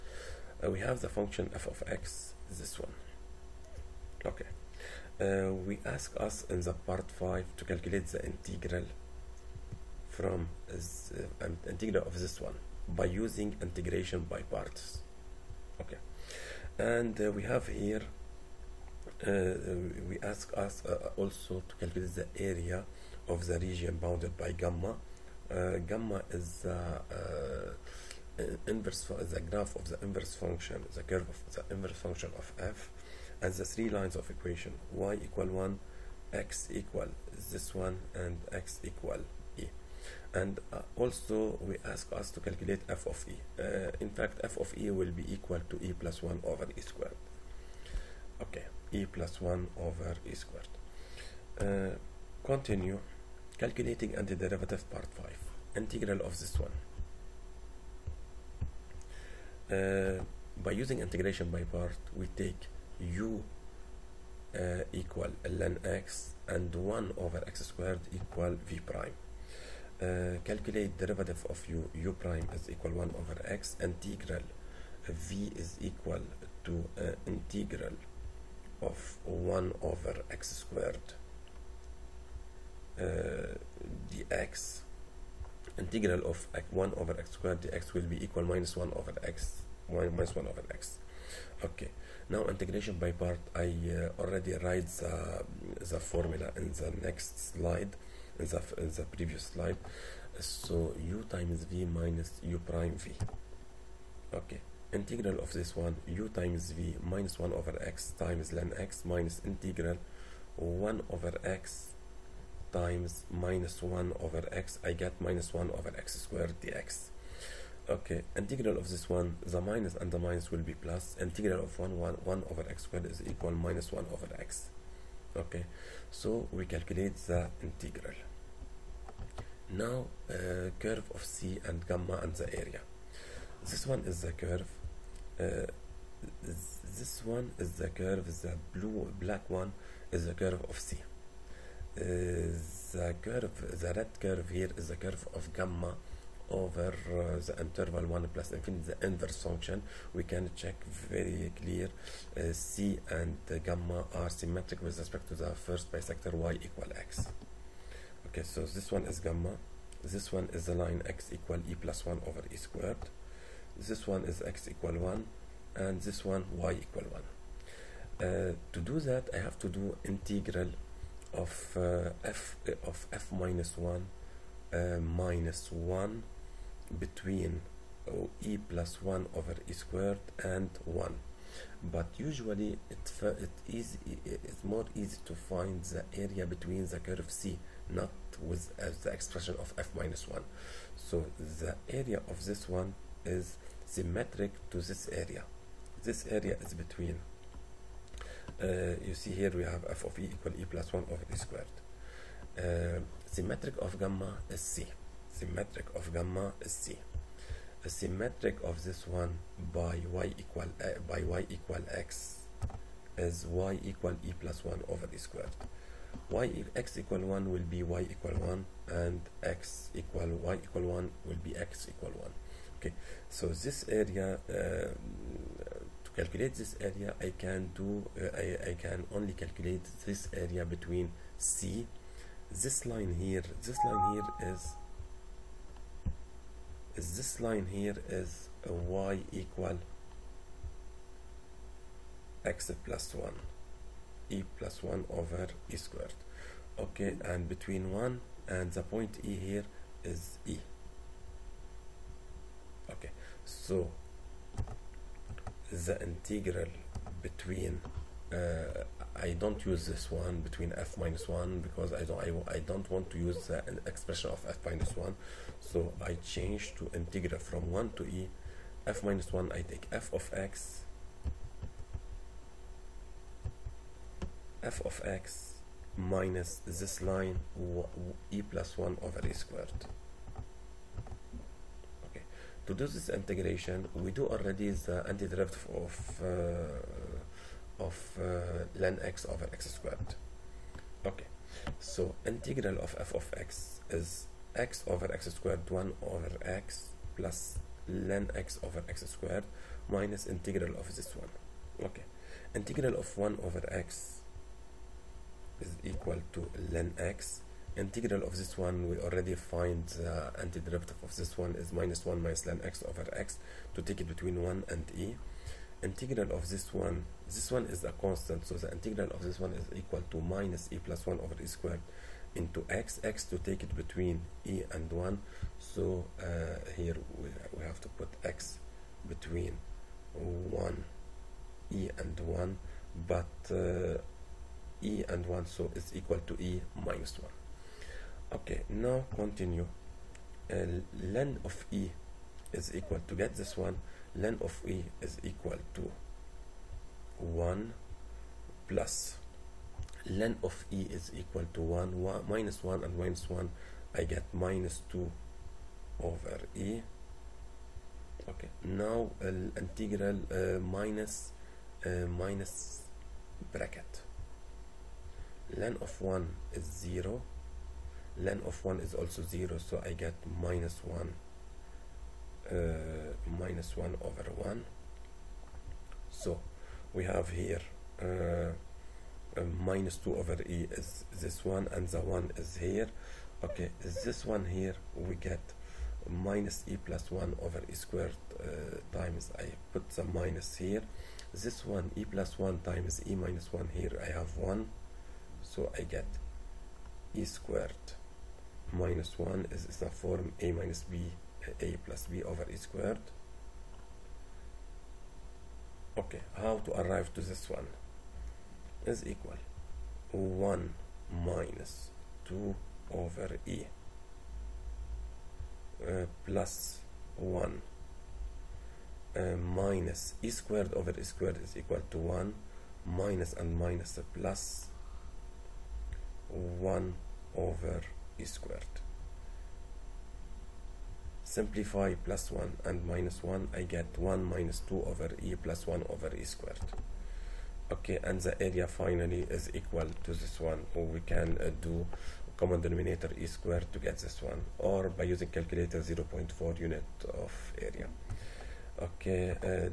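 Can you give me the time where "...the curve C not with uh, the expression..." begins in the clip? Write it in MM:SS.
03:06.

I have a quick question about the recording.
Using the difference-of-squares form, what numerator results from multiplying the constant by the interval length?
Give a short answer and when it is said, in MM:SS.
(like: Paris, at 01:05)
e squared minus 1, at 06:37.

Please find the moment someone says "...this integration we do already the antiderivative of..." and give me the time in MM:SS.
04:42.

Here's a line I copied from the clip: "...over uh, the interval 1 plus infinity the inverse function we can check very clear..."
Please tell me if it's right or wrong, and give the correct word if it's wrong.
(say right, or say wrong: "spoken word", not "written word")
right.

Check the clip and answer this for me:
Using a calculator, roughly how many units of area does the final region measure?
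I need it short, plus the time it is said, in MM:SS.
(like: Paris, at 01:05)
0.4, at 07:25.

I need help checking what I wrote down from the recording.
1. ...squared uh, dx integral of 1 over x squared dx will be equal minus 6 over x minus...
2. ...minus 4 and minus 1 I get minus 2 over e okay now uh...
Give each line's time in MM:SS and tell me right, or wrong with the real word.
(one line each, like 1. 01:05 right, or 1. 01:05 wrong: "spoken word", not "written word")
1. 01:20 wrong: "1", not "6"
2. 05:52 wrong: "1", not "4".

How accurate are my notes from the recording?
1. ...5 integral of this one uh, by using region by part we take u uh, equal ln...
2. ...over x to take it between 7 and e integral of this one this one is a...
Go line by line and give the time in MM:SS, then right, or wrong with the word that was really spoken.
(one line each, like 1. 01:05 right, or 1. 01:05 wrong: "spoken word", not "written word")
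1. 00:55 wrong: "integration", not "region"
2. 05:12 wrong: "1", not "7".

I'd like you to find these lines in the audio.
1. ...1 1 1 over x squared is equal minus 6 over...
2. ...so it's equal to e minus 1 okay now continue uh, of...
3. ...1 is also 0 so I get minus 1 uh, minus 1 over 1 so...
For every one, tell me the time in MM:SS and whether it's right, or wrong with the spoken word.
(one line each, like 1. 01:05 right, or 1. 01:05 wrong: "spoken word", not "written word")
1. 02:01 wrong: "1", not "6"
2. 05:35 right
3. 06:08 right.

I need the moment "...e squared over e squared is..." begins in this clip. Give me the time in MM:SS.
07:00.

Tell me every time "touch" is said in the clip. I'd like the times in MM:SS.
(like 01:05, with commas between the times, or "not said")
not said.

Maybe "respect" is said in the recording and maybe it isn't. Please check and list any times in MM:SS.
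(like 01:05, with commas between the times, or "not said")
02:34.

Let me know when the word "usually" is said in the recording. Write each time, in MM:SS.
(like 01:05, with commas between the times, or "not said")
03:02.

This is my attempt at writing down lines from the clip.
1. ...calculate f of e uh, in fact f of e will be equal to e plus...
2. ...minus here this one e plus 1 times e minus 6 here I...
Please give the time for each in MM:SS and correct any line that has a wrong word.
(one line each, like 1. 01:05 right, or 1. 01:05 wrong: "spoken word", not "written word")
1. 00:42 right
2. 06:30 wrong: "1", not "6".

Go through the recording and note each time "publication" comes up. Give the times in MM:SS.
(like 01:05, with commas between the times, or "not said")
not said.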